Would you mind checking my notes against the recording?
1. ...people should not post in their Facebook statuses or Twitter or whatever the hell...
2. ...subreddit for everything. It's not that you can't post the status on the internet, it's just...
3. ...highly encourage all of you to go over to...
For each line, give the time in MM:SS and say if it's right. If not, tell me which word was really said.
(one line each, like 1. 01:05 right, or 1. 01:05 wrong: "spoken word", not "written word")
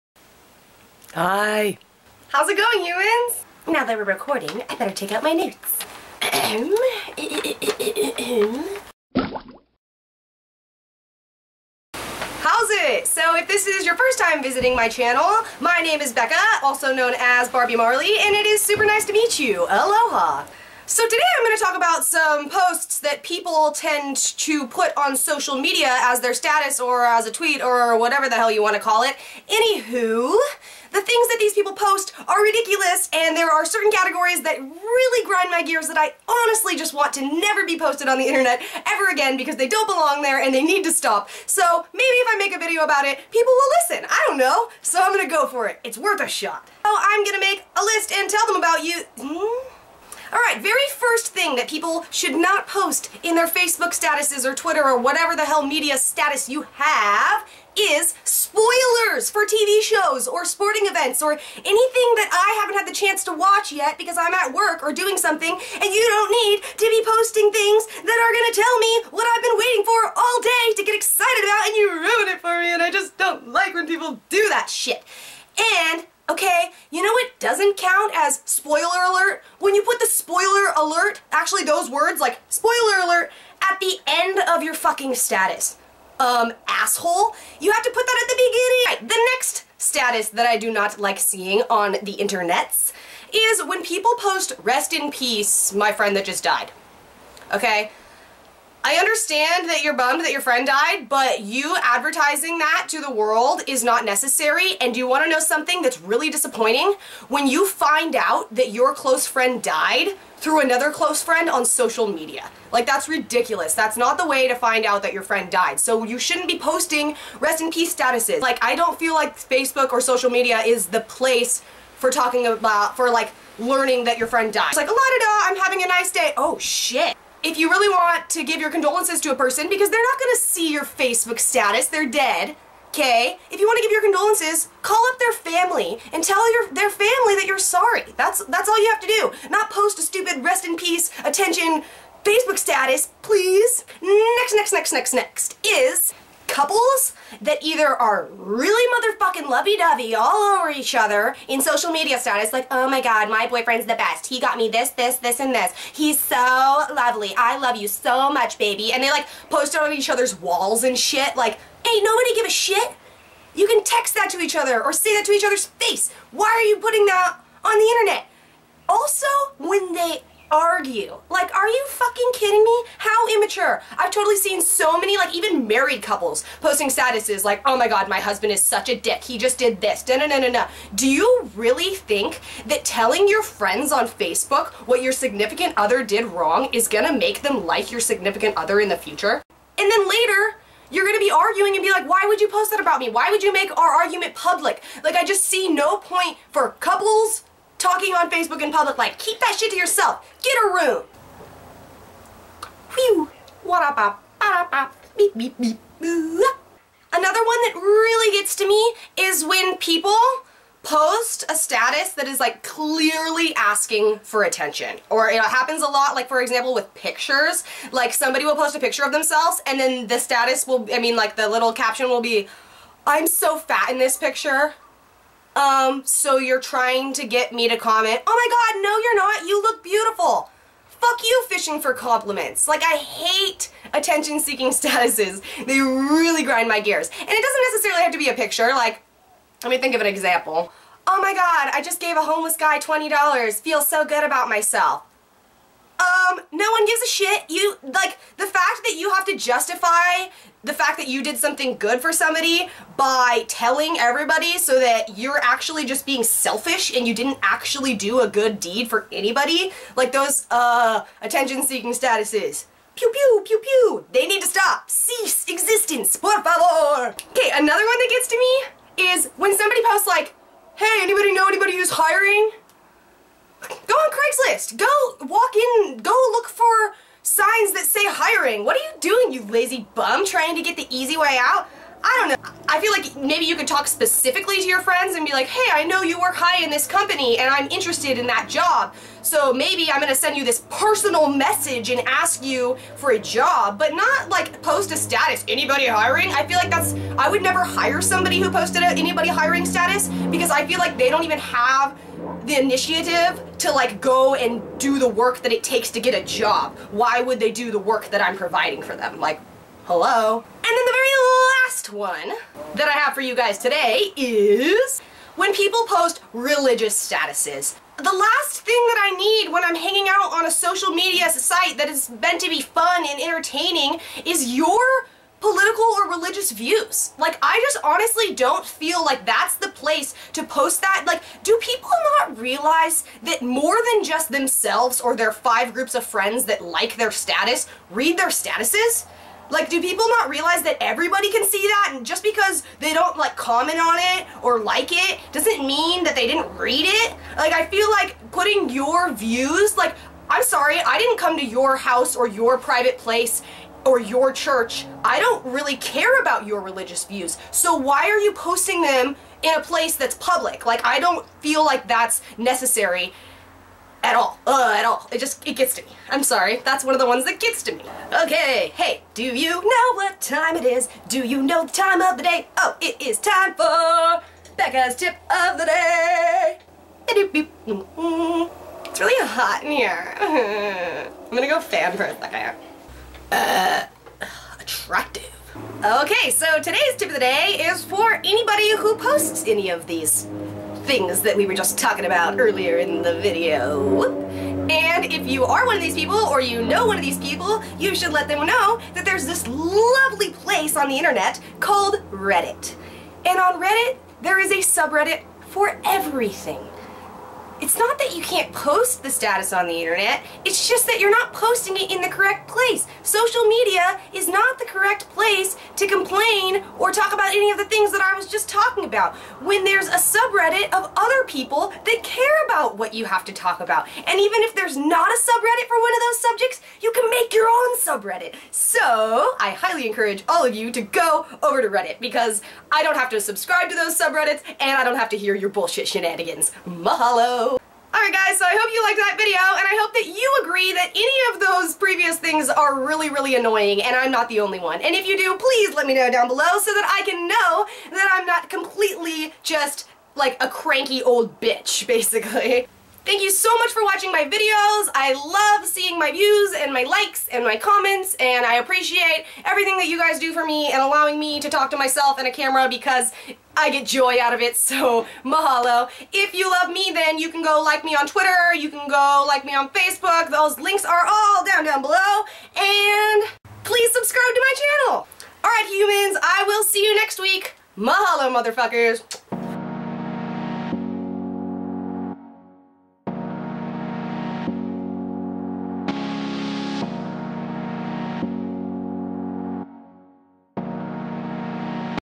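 1. 00:51 right
2. 06:44 right
3. 07:09 right.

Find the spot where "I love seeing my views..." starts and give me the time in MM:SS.
07:34.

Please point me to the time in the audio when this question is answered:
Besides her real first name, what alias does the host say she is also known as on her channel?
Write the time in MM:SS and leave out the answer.
00:17.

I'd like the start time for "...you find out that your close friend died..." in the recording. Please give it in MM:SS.
01:47.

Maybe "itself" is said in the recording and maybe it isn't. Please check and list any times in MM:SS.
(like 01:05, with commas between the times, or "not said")
not said.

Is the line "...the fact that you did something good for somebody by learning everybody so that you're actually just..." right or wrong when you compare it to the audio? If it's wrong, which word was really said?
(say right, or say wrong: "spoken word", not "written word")
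wrong: "telling", not "learning".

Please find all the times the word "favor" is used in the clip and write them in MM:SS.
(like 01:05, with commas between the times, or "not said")
04:26.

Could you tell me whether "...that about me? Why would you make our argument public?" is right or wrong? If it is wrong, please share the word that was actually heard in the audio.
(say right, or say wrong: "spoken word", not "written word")
right.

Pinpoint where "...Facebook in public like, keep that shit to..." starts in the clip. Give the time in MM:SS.
03:18.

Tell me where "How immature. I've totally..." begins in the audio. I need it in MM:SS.
02:52.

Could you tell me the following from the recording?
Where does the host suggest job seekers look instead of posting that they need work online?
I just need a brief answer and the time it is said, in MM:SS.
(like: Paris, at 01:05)
Craigslist, at 04:34.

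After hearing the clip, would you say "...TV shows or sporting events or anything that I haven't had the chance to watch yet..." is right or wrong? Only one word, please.
right.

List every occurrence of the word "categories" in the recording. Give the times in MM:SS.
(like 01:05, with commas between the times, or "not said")
00:33.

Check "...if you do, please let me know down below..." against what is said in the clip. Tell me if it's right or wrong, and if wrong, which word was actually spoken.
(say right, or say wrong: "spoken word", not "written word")
right.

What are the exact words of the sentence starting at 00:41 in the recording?
So maybe if I make a video about it, people will listen.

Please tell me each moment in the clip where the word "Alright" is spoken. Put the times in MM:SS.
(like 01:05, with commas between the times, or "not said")
00:50, 07:17, 07:55.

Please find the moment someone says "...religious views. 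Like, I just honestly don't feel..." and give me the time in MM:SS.
05:26.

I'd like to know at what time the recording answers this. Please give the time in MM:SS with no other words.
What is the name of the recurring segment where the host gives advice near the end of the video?
06:14.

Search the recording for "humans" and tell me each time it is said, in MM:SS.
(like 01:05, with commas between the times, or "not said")
00:02, 07:55.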